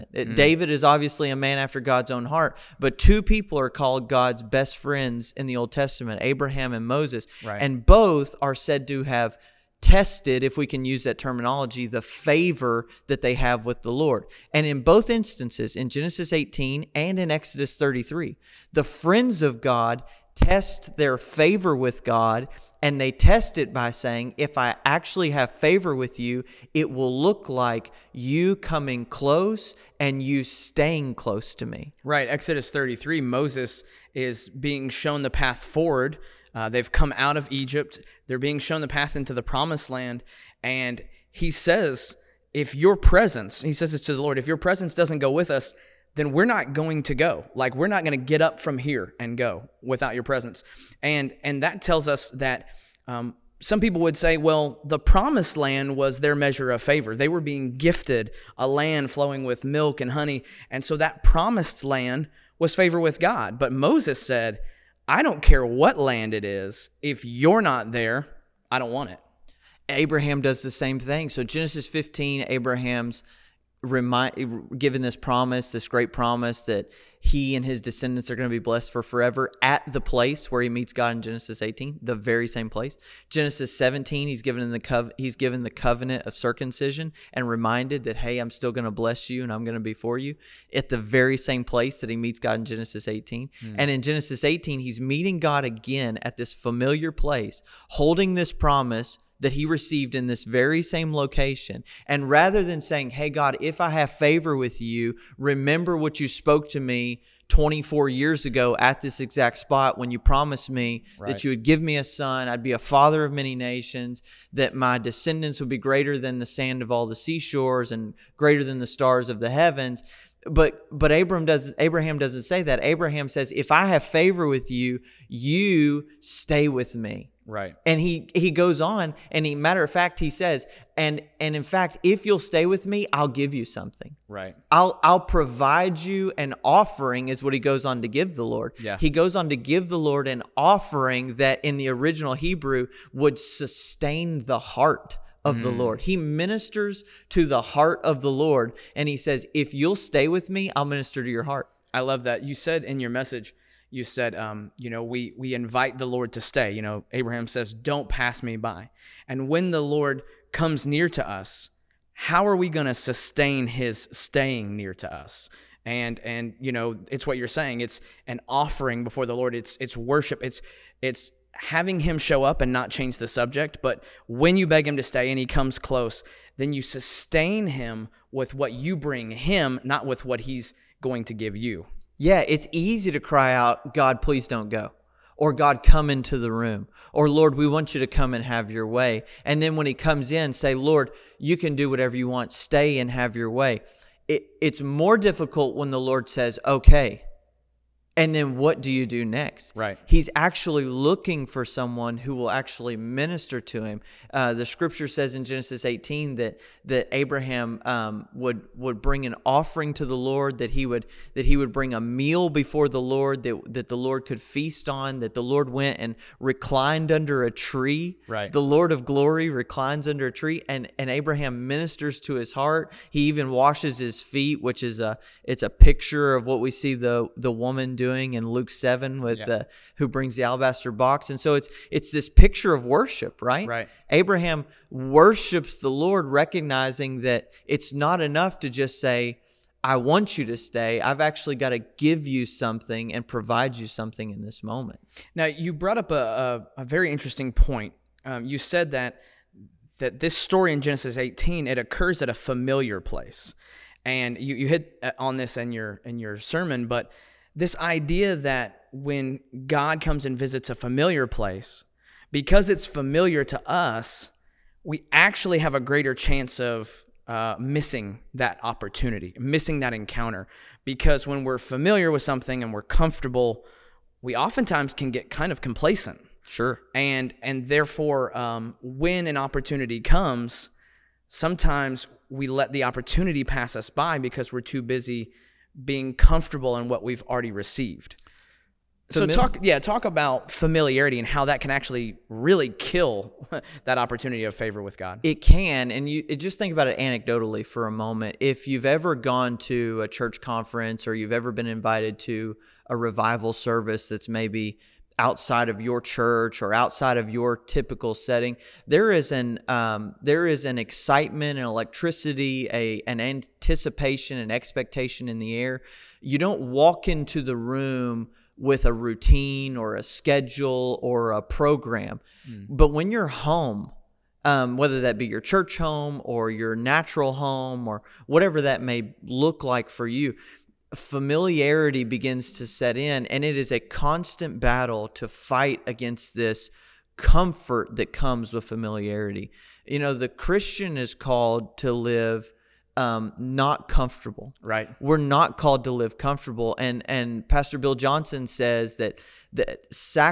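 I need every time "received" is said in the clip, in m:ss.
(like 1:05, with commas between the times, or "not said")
1:39, 4:47.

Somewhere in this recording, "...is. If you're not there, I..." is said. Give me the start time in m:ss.
1:06.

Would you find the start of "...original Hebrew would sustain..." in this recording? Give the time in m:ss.
2:21.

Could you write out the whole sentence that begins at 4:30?
Because when we're familiar with something and we're comfortable, we oftentimes can get kind of complacent.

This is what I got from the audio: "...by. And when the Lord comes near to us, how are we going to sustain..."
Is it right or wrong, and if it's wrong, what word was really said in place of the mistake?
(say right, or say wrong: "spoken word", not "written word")
right.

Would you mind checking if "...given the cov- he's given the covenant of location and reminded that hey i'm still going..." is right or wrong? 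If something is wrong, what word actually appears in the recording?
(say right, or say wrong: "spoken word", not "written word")
wrong: "circumcision", not "location".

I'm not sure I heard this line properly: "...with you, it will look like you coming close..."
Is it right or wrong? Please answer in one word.
right.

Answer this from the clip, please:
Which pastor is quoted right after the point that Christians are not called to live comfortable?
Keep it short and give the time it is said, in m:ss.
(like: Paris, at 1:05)
Bill Johnson, at 5:47.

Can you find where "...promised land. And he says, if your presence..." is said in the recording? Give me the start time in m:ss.
0:39.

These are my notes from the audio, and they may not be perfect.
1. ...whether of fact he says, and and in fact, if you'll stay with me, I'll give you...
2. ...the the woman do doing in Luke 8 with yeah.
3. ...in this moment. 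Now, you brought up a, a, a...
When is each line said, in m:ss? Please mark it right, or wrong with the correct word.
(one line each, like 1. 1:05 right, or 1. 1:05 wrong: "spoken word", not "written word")
1. 2:09 wrong: "matter", not "whether"
2. 3:46 wrong: "7", not "8"
3. 4:04 right.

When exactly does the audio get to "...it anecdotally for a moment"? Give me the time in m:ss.
4:56.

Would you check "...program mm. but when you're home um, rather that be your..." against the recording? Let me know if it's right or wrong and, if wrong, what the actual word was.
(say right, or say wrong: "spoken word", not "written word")
wrong: "whether", not "rather".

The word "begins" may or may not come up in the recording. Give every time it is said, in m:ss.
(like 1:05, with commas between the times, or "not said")
5:32.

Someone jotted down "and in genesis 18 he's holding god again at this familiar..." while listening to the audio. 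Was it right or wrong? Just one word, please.
wrong.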